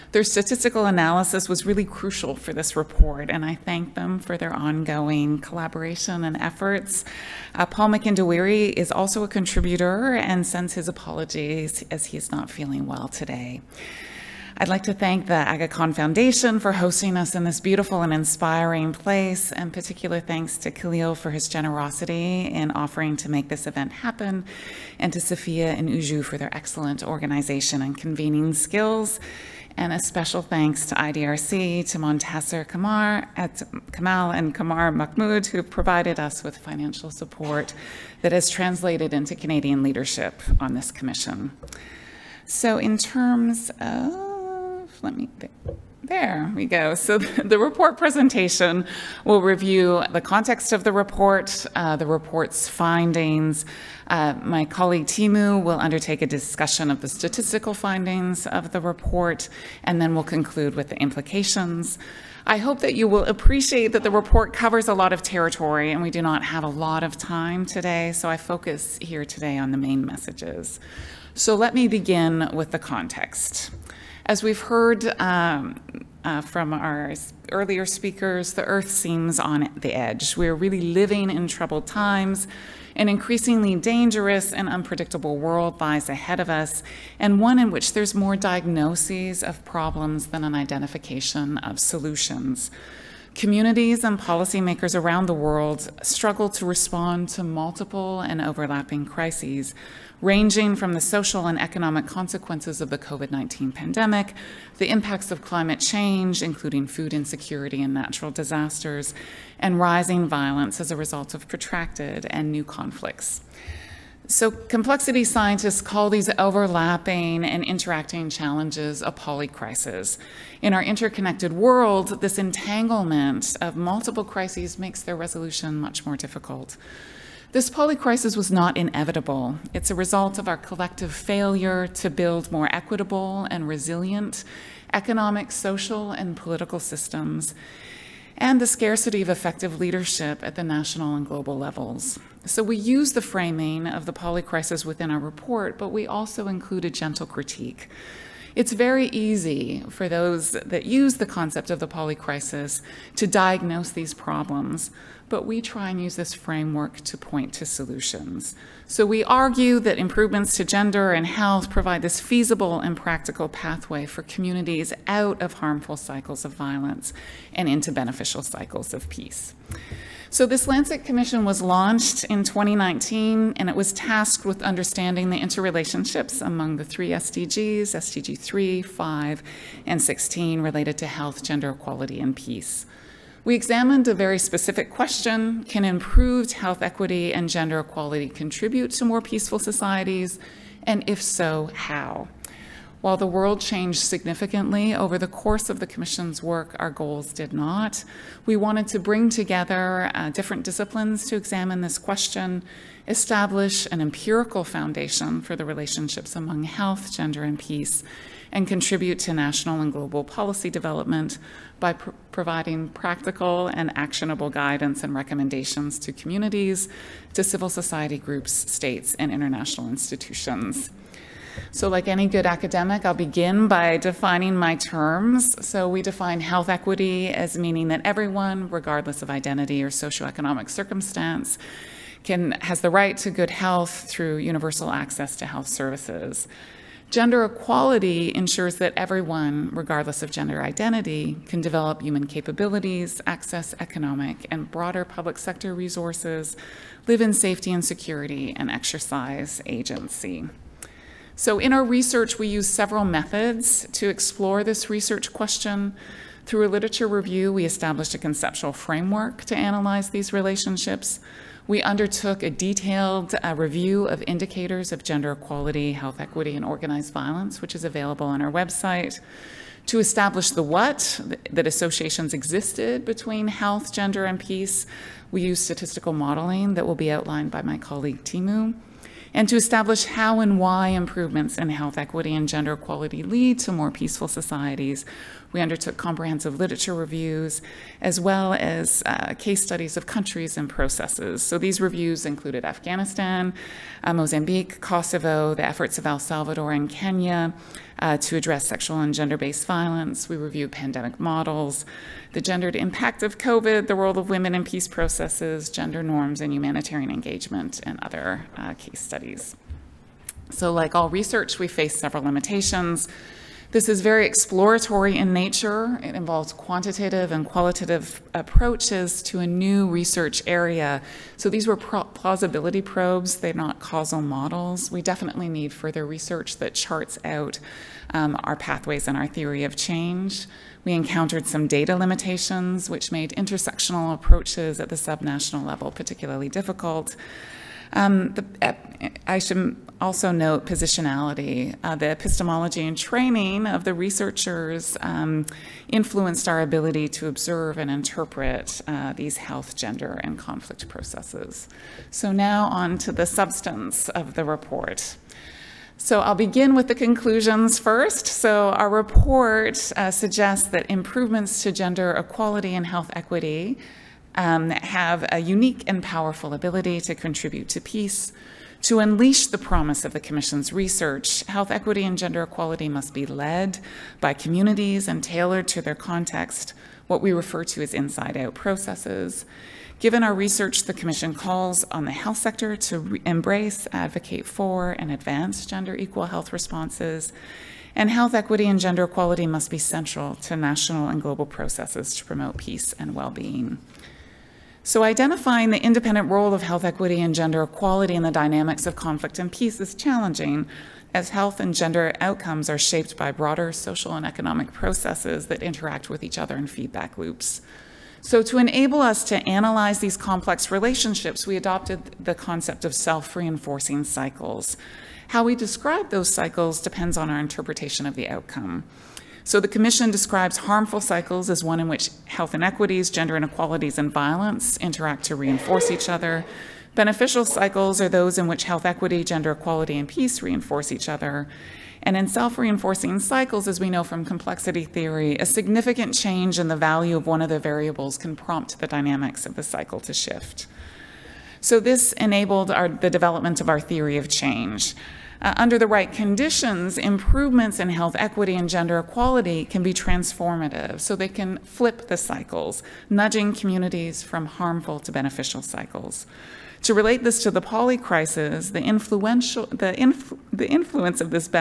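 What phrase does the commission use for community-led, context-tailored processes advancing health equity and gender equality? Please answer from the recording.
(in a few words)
inside-out processes.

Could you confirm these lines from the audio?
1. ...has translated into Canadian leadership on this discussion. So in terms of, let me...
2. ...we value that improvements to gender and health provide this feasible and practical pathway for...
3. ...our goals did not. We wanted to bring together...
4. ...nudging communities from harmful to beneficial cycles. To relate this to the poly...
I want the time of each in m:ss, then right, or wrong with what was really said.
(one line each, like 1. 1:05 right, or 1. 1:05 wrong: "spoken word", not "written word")
1. 0:38 wrong: "commission", not "discussion"
2. 2:39 wrong: "argue", not "value"
3. 3:16 right
4. 7:33 right.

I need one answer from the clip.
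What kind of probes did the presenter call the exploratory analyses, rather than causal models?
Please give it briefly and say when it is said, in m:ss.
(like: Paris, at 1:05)
plausibility probes, at 5:21.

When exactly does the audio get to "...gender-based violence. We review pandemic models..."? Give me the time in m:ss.
4:59.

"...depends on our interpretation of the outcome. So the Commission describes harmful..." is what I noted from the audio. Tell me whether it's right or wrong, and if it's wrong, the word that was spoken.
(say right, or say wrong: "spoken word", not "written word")
right.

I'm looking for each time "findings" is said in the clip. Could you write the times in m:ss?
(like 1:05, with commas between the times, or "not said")
0:52, 0:57.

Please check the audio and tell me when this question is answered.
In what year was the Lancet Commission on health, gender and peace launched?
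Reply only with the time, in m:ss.
2:52.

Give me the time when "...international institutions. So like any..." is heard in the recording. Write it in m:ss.
3:39.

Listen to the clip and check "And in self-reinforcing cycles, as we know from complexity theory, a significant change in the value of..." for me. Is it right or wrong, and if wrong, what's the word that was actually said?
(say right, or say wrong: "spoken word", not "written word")
right.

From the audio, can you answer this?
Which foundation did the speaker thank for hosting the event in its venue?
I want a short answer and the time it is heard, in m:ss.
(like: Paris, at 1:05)
Aga Khan Foundation, at 0:15.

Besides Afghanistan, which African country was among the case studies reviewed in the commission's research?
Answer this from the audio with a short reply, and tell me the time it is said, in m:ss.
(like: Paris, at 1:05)
Mozambique, at 4:54.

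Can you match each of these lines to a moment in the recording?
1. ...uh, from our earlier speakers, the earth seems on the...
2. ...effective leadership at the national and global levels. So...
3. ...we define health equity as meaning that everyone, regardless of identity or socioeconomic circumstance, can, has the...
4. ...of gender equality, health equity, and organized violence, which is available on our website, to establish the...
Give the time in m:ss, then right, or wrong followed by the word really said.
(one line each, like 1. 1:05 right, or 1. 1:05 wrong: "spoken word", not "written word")
1. 1:16 right
2. 2:19 right
3. 3:45 right
4. 4:24 right.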